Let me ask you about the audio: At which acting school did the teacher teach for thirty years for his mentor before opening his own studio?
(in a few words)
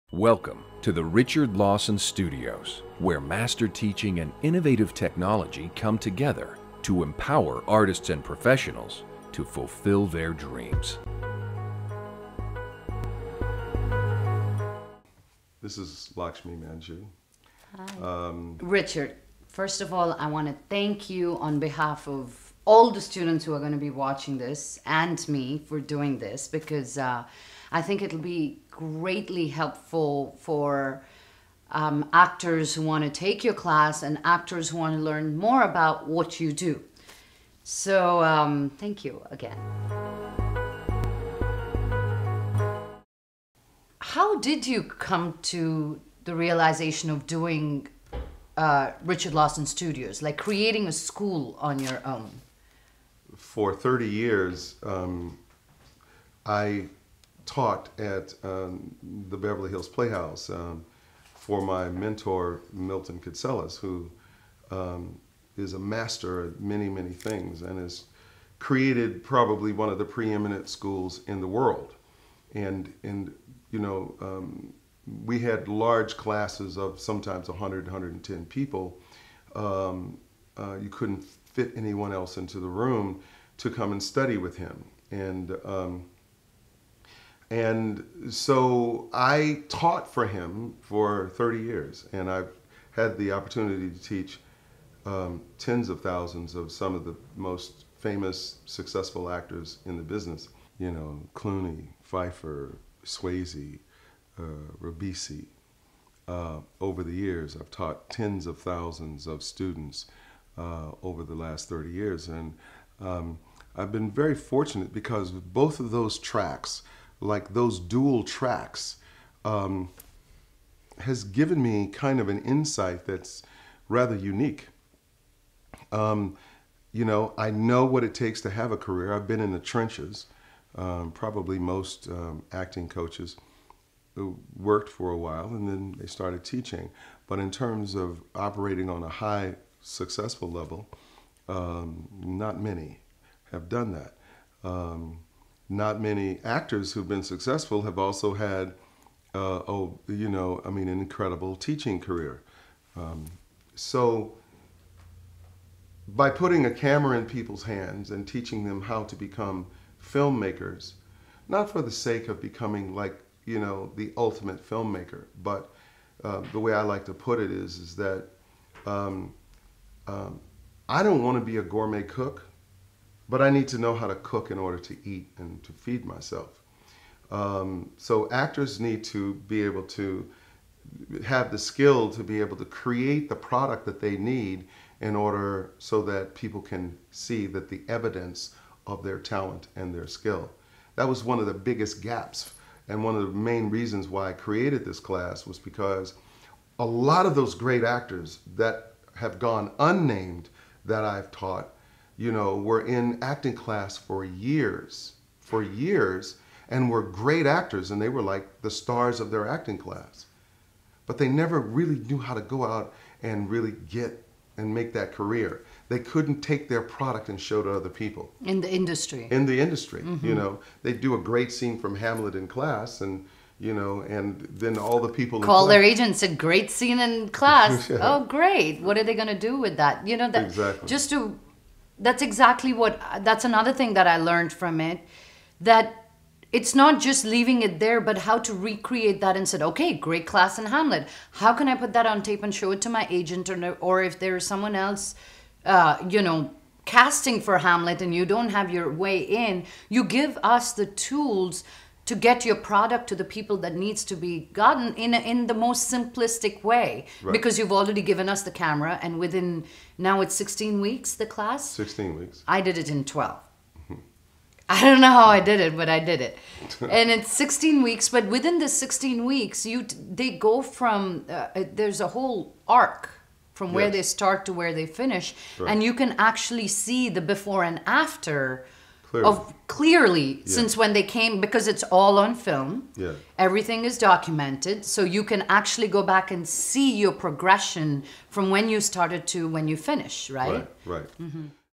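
Beverly Hills Playhouse.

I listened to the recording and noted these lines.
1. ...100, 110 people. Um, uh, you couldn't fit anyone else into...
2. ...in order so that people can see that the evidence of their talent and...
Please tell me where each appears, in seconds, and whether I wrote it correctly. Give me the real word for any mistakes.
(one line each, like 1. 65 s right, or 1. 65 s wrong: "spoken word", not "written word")
1. 77 s right
2. 184 s right.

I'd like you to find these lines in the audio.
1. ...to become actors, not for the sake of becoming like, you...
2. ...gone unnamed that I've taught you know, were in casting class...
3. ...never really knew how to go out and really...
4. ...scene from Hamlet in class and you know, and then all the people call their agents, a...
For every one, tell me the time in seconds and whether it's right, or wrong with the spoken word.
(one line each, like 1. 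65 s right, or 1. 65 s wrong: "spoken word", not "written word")
1. 159 s wrong: "filmmakers", not "actors"
2. 199 s wrong: "acting", not "casting"
3. 211 s right
4. 221 s right.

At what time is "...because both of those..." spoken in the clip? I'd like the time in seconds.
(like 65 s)
114 s.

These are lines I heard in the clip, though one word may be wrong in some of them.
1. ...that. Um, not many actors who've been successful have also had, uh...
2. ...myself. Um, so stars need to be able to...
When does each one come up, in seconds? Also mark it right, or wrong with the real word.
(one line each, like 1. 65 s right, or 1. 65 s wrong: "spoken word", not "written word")
1. 143 s right
2. 176 s wrong: "actors", not "stars".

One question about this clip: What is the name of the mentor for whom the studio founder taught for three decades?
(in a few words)
Milton Katselas.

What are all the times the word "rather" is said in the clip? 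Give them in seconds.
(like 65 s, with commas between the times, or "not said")
123 s.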